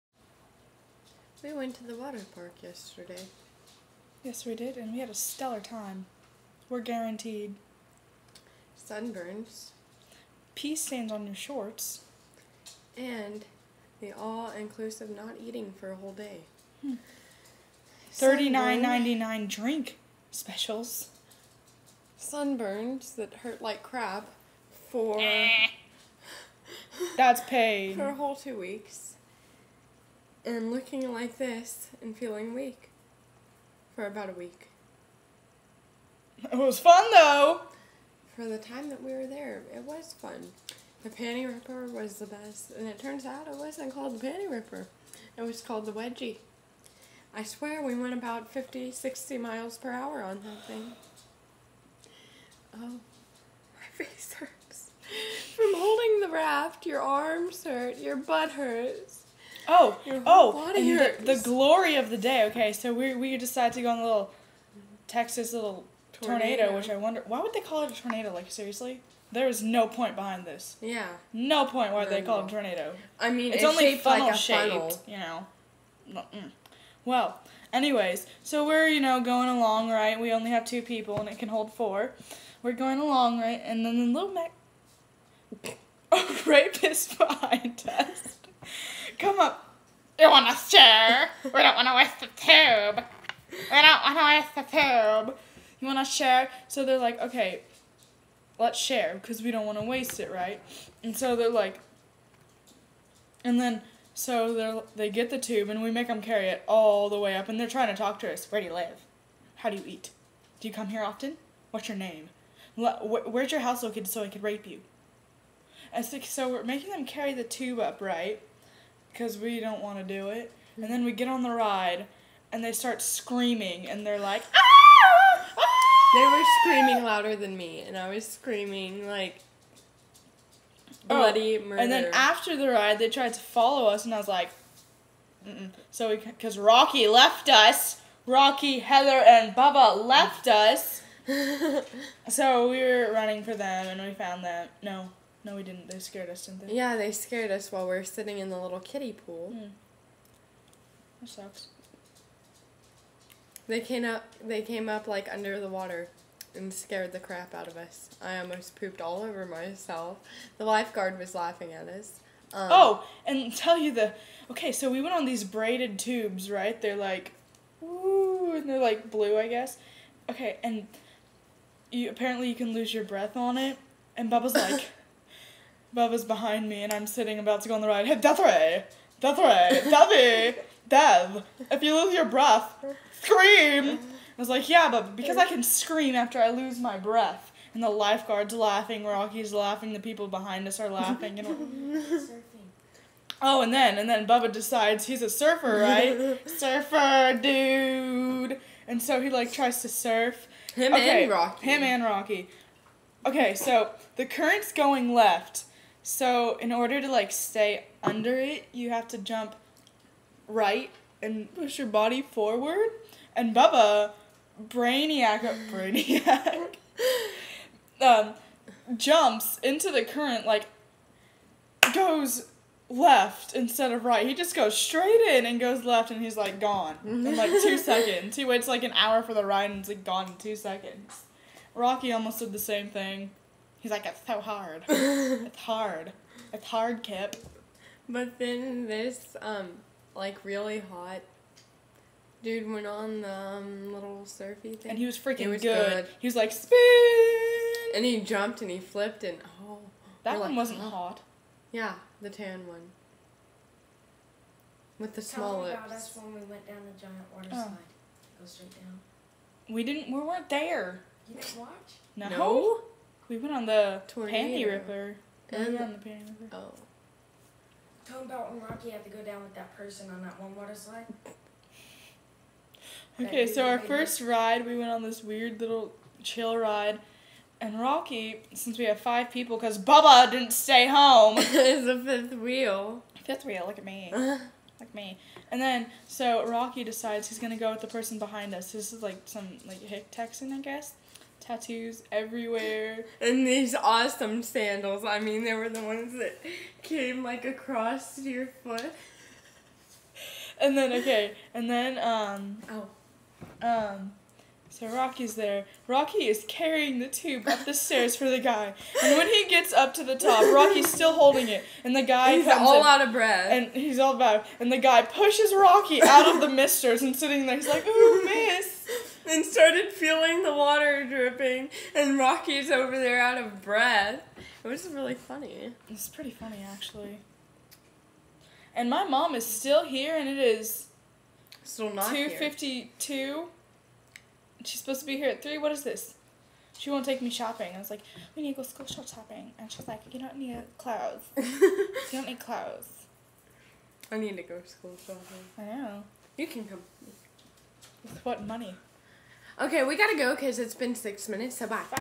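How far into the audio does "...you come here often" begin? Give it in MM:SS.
01:50.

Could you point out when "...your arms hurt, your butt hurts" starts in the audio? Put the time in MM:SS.
00:56.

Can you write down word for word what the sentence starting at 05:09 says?
And when he gets up to the top, Rocky's still holding it.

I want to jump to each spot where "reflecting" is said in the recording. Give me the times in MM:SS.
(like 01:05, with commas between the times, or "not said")
not said.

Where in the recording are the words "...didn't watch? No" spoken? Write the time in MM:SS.
04:21.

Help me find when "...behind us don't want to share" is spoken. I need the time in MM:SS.
01:27.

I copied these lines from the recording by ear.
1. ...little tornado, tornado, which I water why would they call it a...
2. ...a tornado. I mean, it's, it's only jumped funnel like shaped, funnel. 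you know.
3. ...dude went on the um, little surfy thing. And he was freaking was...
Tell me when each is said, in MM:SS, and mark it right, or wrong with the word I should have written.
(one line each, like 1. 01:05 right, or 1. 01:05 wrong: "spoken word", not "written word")
1. 01:05 wrong: "wonder", not "water"
2. 01:12 wrong: "shaped", not "jumped"
3. 04:02 right.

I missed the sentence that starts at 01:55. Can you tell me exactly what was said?
And so we're making them carry the tube up, right?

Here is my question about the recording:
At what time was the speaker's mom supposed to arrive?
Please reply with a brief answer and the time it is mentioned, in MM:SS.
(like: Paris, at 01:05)
3:00, at 05:35.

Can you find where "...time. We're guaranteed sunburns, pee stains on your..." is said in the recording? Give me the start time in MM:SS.
00:05.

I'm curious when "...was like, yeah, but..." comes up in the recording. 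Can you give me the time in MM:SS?
03:04.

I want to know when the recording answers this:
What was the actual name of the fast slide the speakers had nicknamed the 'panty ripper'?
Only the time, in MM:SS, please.
00:45.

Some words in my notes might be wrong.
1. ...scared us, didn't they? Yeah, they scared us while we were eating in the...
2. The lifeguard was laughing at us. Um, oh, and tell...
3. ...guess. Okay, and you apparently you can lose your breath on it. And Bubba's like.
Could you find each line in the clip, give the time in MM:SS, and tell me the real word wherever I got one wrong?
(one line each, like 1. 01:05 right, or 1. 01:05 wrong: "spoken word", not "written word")
1. 02:25 wrong: "sitting", not "eating"
2. 02:40 right
3. 02:49 right.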